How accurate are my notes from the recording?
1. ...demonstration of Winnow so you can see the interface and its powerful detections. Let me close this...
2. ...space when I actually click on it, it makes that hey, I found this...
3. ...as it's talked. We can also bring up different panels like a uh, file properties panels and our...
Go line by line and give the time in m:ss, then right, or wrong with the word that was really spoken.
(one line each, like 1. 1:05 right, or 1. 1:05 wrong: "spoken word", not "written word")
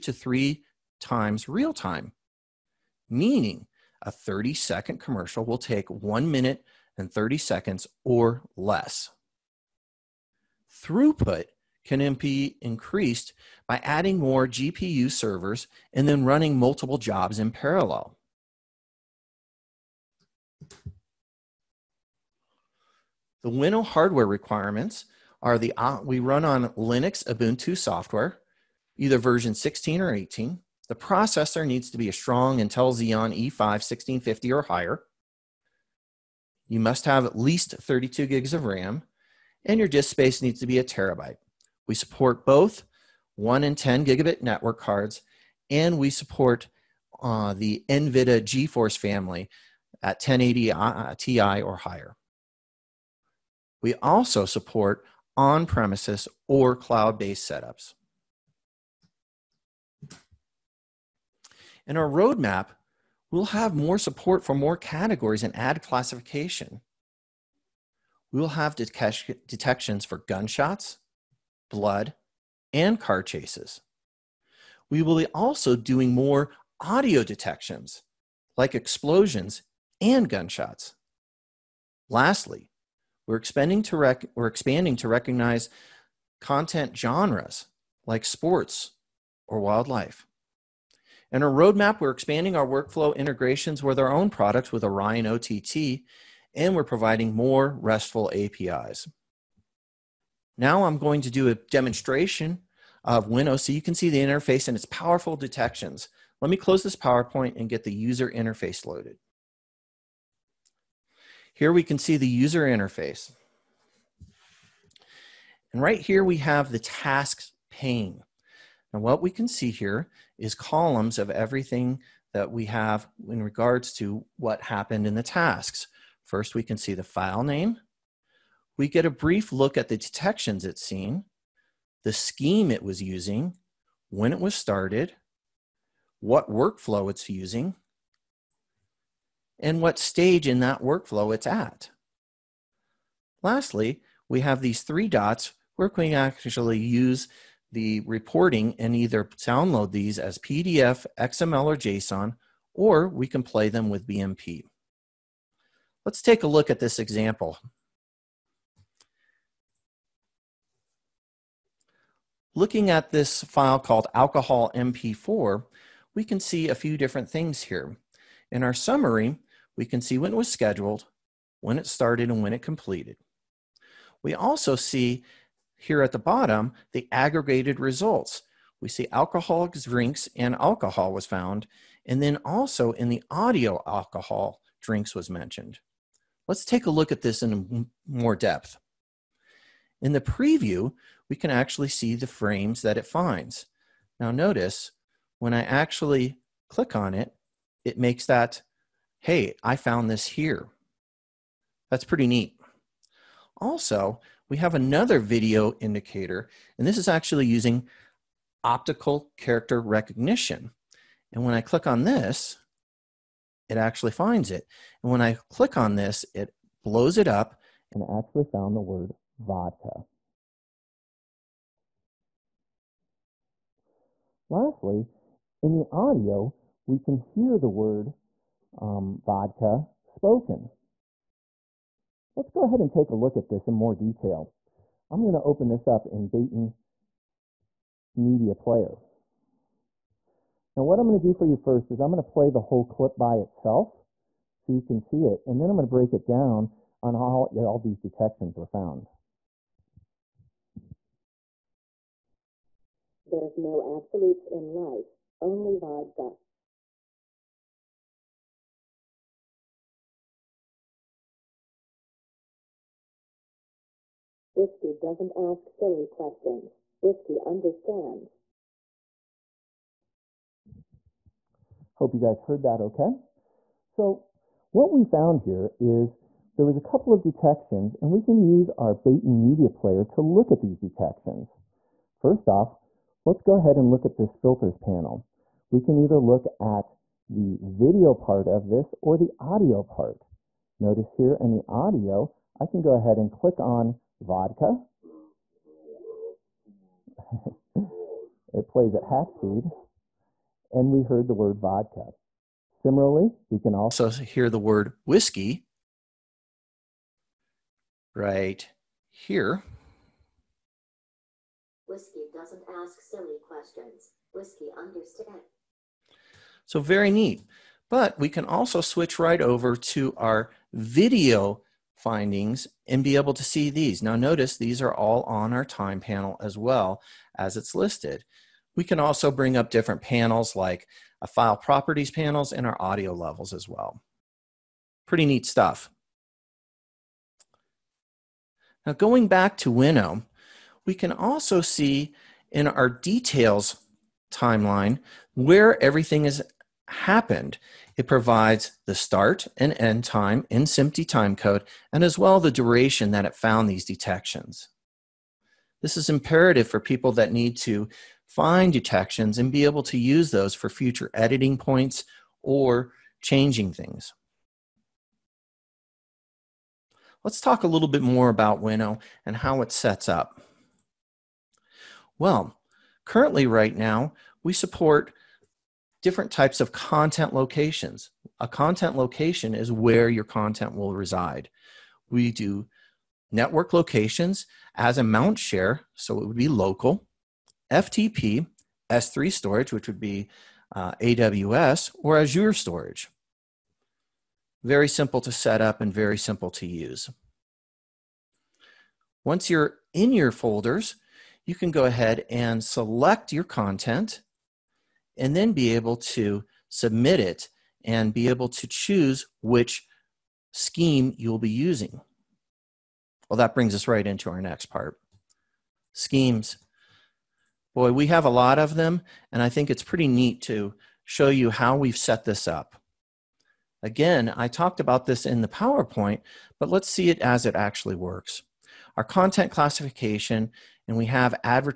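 1. 1:41 right
2. 3:14 wrong: "notice", not "space"
3. 5:27 wrong: "listed", not "talked".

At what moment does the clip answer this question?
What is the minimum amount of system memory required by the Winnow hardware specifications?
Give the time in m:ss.
0:37.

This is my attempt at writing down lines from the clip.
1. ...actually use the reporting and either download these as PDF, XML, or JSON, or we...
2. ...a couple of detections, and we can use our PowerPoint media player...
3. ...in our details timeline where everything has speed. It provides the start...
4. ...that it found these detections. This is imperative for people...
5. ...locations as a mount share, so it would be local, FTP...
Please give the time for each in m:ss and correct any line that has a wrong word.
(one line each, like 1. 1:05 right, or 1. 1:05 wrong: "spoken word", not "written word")
1. 2:26 right
2. 4:36 wrong: "Baton", not "PowerPoint"
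3. 5:42 wrong: "happened", not "speed"
4. 5:53 right
5. 6:23 right.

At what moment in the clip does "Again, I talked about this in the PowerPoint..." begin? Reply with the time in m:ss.
7:03.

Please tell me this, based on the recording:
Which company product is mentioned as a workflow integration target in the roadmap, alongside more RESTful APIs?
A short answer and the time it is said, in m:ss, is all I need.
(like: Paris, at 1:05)
Orion OTT, at 1:34.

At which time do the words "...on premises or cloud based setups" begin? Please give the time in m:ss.
0:55.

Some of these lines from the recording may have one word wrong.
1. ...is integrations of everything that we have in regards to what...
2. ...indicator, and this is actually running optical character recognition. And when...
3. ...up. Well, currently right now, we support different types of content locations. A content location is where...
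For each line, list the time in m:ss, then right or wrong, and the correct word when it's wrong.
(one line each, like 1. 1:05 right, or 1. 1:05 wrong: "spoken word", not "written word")
1. 2:00 wrong: "columns", not "integrations"
2. 3:25 wrong: "using", not "running"
3. 6:10 right.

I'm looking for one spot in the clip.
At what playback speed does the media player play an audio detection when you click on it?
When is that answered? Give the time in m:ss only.
4:59.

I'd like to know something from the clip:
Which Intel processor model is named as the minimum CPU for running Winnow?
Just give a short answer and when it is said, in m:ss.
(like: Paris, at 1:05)
Xeon E5 1650, at 0:32.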